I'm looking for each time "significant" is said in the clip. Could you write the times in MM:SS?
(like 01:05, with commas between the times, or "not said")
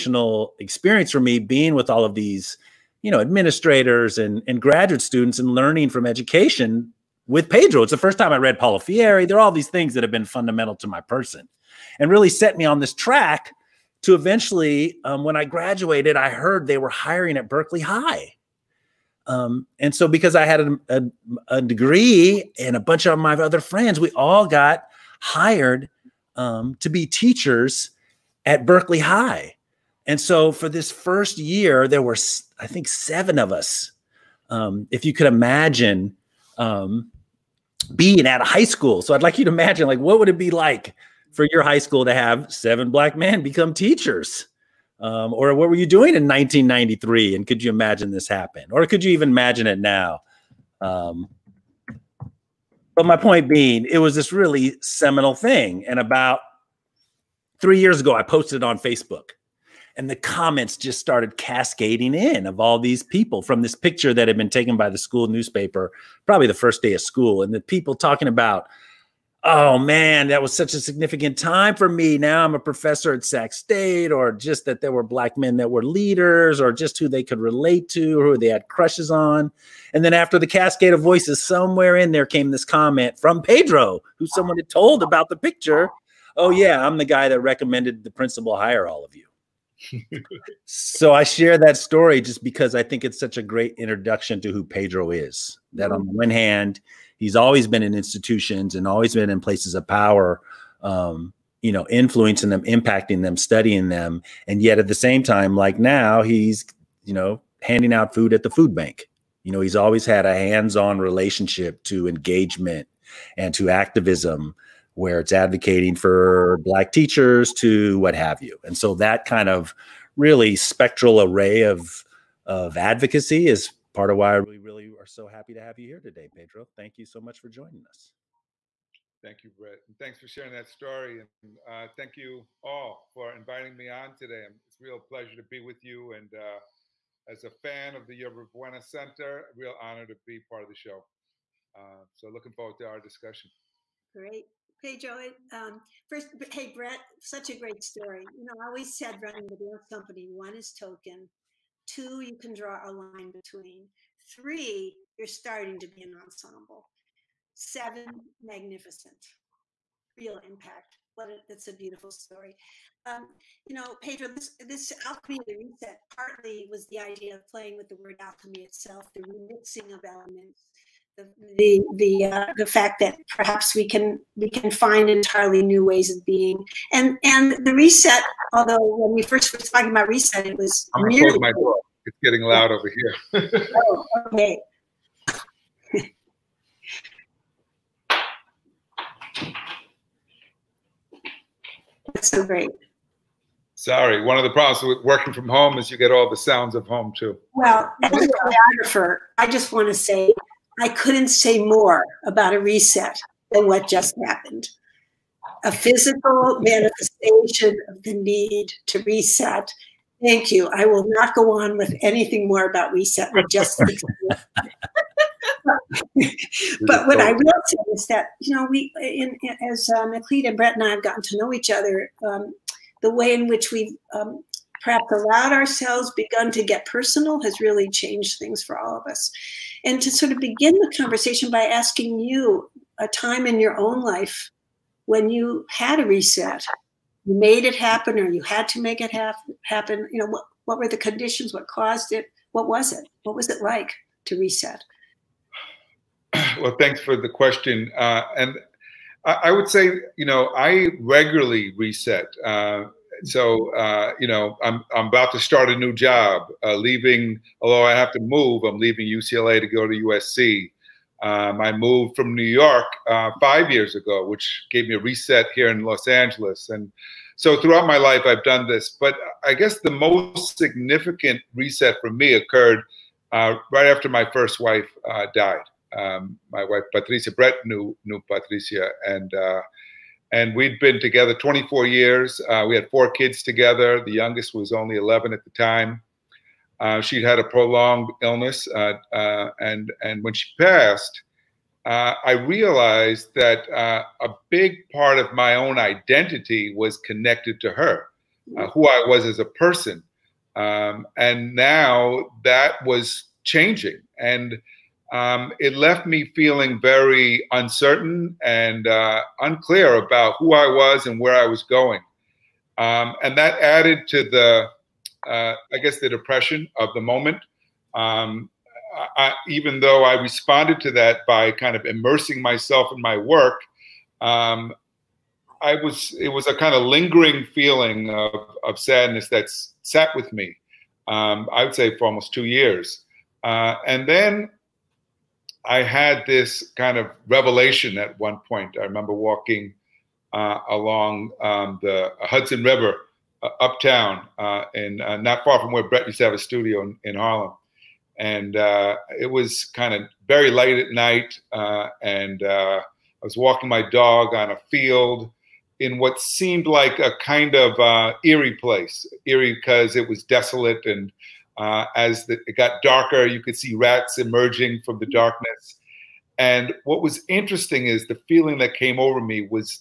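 01:10, 04:30.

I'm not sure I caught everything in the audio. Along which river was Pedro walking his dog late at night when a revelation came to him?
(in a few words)
Hudson River.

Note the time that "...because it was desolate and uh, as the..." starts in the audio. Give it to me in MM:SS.
05:59.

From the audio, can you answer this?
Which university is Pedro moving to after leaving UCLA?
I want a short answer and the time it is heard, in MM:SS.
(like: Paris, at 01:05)
USC, at 04:19.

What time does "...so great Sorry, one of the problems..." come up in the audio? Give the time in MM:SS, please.
03:12.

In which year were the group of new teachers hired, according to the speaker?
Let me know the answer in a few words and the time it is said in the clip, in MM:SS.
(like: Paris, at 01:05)
1993, at 00:46.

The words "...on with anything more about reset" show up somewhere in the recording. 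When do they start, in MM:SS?
03:31.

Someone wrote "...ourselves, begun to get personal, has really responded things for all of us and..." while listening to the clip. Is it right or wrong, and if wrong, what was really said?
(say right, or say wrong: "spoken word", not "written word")
wrong: "changed", not "responded".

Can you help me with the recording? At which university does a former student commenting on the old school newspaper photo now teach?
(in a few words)
Sac State.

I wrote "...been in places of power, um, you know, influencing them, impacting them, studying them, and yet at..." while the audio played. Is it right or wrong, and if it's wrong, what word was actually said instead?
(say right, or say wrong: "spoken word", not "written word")
right.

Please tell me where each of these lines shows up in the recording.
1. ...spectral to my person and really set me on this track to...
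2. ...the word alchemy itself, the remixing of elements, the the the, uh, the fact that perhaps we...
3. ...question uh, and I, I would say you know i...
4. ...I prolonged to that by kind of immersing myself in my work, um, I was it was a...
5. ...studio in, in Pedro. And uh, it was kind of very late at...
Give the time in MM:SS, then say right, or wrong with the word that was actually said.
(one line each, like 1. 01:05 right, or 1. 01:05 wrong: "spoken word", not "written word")
1. 00:10 wrong: "fundamental", not "spectral"
2. 02:47 right
3. 04:07 right
4. 05:20 wrong: "responded", not "prolonged"
5. 05:46 wrong: "Harlem", not "Pedro".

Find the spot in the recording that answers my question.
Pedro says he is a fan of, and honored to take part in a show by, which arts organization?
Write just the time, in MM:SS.
02:18.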